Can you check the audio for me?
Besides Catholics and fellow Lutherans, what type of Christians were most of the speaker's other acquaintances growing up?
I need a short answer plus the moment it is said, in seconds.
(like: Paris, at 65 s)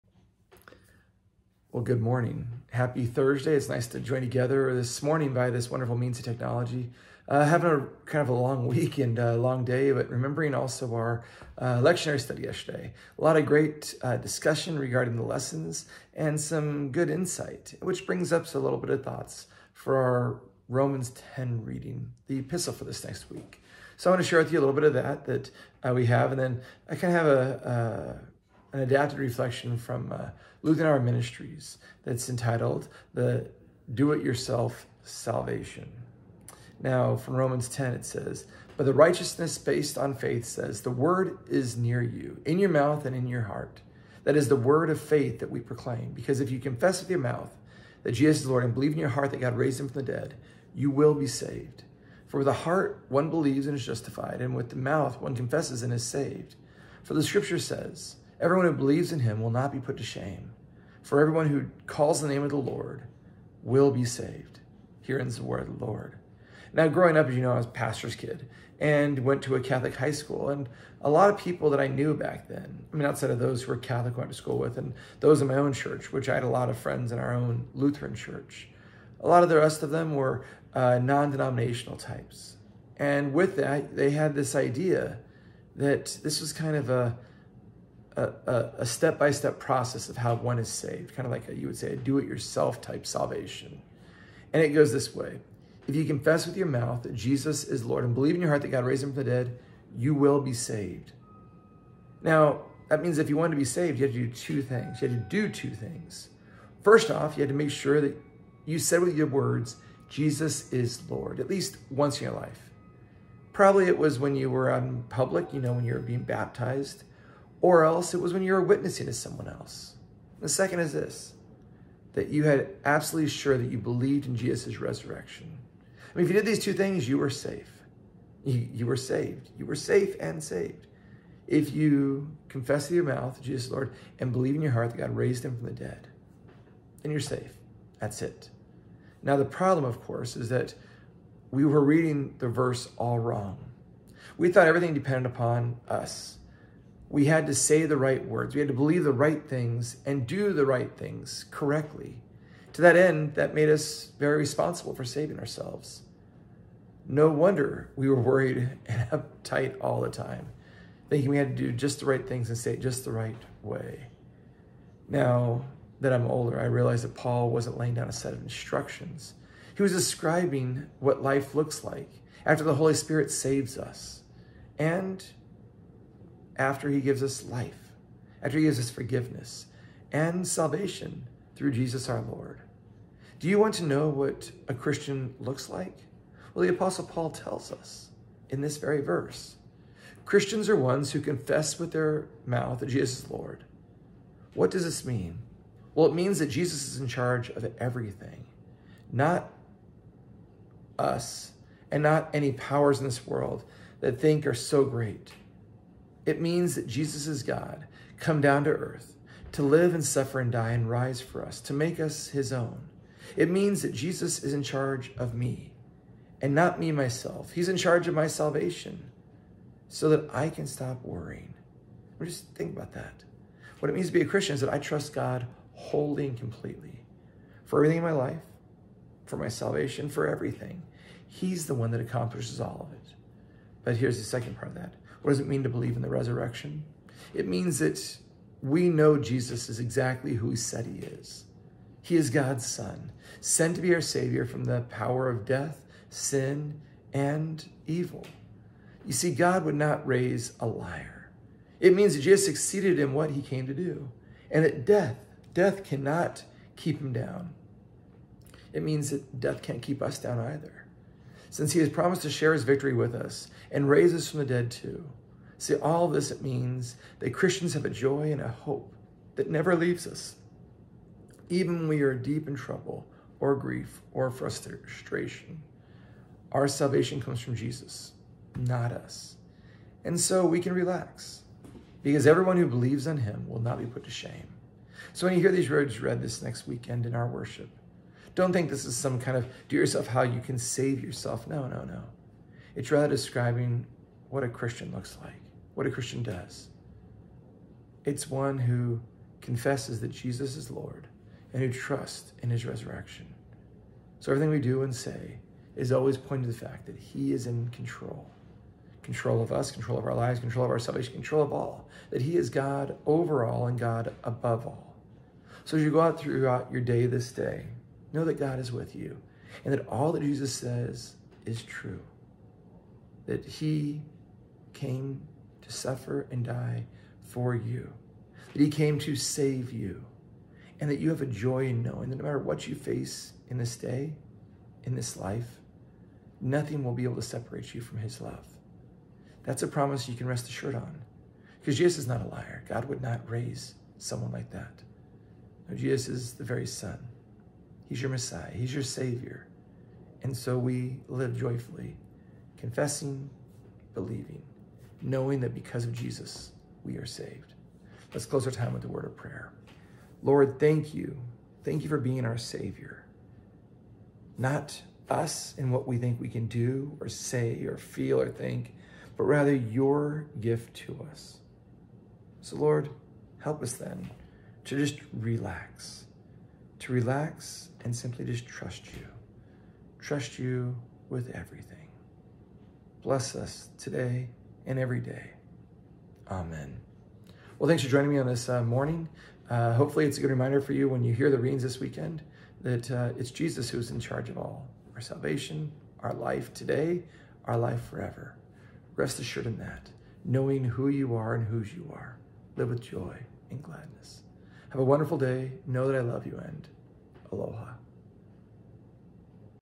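non denominational, at 80 s.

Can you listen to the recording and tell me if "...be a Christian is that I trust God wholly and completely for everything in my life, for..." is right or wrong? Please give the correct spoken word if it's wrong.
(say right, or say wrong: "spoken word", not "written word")
right.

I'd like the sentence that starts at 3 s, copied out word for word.
It's nice to join together this morning by this wonderful means of technology.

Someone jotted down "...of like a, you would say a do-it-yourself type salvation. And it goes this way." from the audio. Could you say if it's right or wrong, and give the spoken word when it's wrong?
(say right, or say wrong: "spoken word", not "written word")
right.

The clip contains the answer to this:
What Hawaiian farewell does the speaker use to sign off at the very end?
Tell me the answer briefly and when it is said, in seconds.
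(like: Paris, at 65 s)
aloha, at 407 s.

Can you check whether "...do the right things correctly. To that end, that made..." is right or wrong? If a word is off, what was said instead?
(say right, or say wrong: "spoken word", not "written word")
right.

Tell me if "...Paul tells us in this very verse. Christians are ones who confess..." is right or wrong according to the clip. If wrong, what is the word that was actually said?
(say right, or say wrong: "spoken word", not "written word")
right.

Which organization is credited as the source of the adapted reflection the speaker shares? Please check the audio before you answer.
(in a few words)
Lutheran Ministries.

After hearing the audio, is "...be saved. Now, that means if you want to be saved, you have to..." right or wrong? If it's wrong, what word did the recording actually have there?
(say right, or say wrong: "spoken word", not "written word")
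right.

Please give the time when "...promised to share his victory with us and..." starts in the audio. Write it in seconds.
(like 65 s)
261 s.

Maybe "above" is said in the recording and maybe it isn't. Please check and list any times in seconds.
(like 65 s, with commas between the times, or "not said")
314 s.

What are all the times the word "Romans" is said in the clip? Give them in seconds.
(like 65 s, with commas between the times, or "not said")
20 s, 37 s.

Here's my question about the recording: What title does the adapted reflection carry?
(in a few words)
The Do It Yourself Salvation.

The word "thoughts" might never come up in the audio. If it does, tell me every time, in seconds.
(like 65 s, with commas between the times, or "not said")
19 s, 144 s.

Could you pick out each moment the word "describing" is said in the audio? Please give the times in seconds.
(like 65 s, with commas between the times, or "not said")
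169 s, 293 s.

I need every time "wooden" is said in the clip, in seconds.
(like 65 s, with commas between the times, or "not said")
not said.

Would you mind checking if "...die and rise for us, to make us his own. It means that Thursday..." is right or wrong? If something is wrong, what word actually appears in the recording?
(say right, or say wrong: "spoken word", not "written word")
wrong: "Jesus", not "Thursday".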